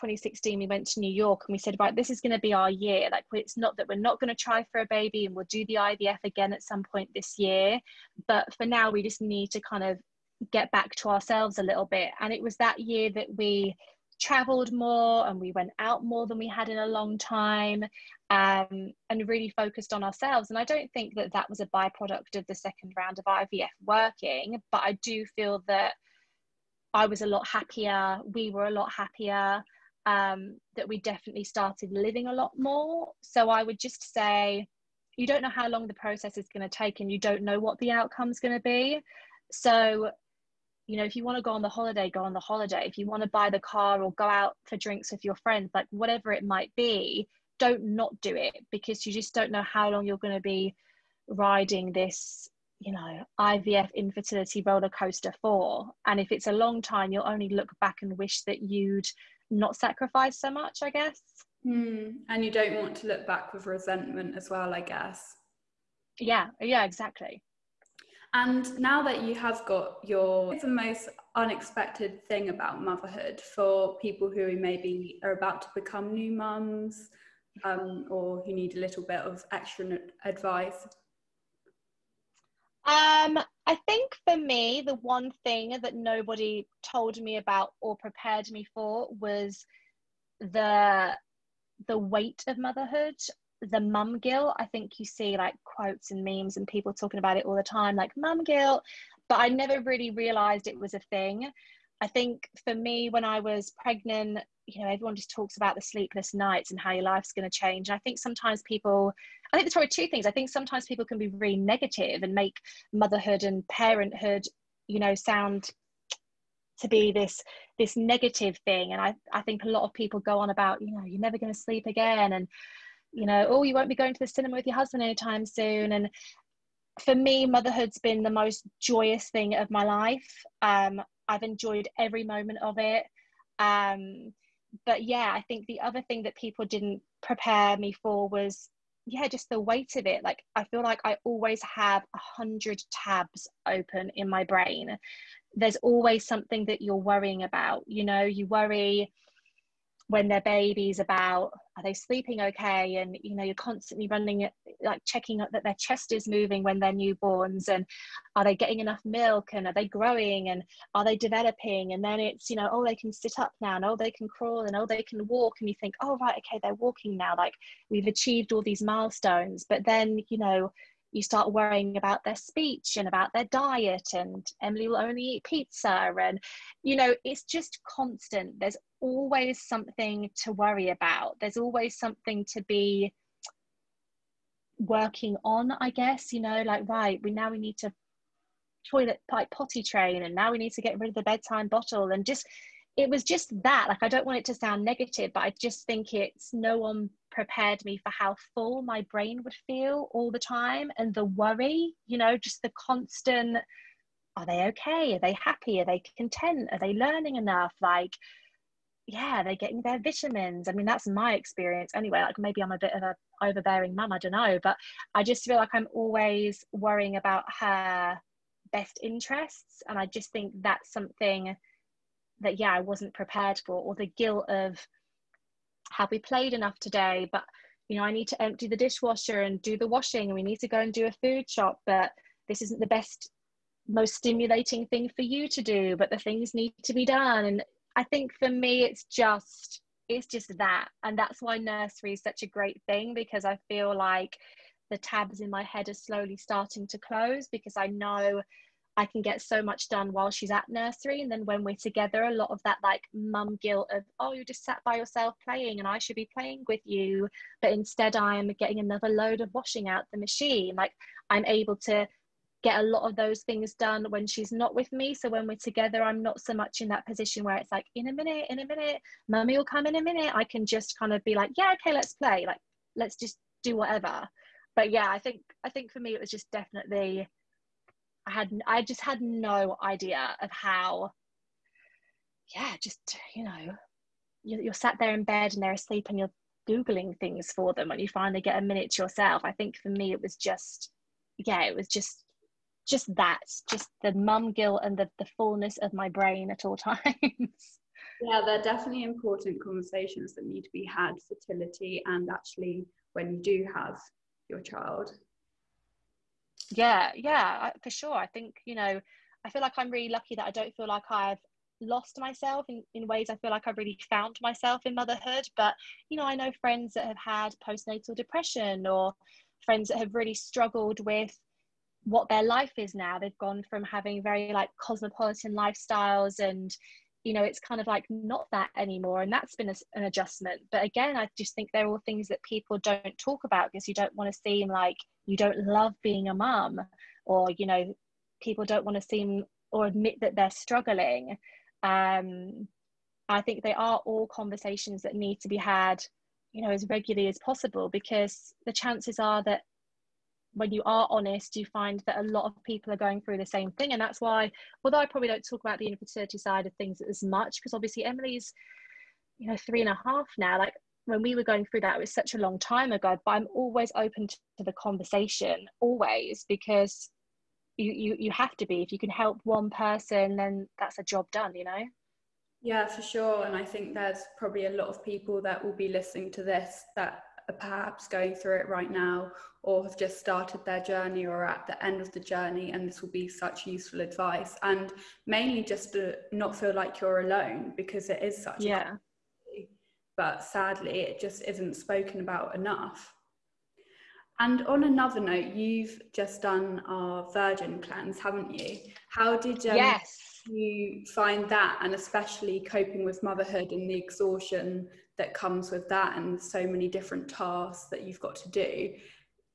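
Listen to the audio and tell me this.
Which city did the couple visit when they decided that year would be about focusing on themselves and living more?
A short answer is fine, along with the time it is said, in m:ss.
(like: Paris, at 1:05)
New York, at 0:01.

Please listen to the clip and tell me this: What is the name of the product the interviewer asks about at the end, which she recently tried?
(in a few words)
Virgin cleanse.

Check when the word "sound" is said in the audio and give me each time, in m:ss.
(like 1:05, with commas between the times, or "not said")
1:55, 3:14.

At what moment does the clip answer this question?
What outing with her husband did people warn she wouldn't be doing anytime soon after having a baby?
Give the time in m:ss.
2:04.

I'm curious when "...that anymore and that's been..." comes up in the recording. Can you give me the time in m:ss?
5:28.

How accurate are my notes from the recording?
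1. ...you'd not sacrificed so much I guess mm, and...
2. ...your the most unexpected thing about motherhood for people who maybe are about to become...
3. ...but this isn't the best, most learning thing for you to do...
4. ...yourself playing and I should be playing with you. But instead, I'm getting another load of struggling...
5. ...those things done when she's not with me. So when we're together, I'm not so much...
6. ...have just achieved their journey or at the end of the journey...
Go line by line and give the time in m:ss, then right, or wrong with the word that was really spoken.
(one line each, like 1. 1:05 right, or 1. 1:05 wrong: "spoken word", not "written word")
1. 0:58 right
2. 1:10 right
3. 3:51 wrong: "stimulating", not "learning"
4. 4:14 wrong: "washing", not "struggling"
5. 4:23 right
6. 6:19 wrong: "started", not "achieved".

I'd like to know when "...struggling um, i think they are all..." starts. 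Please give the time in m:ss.
5:40.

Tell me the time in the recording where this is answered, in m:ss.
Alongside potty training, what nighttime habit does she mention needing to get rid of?
3:11.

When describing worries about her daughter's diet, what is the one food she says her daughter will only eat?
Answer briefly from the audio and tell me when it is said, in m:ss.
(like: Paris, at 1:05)
pizza, at 2:55.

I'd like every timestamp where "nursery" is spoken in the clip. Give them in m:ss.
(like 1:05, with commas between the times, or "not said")
4:01, 4:10.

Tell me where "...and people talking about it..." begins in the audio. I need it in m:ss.
1:36.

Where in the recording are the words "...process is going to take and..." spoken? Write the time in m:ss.
0:35.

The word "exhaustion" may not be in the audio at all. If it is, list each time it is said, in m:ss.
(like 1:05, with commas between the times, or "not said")
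6:43.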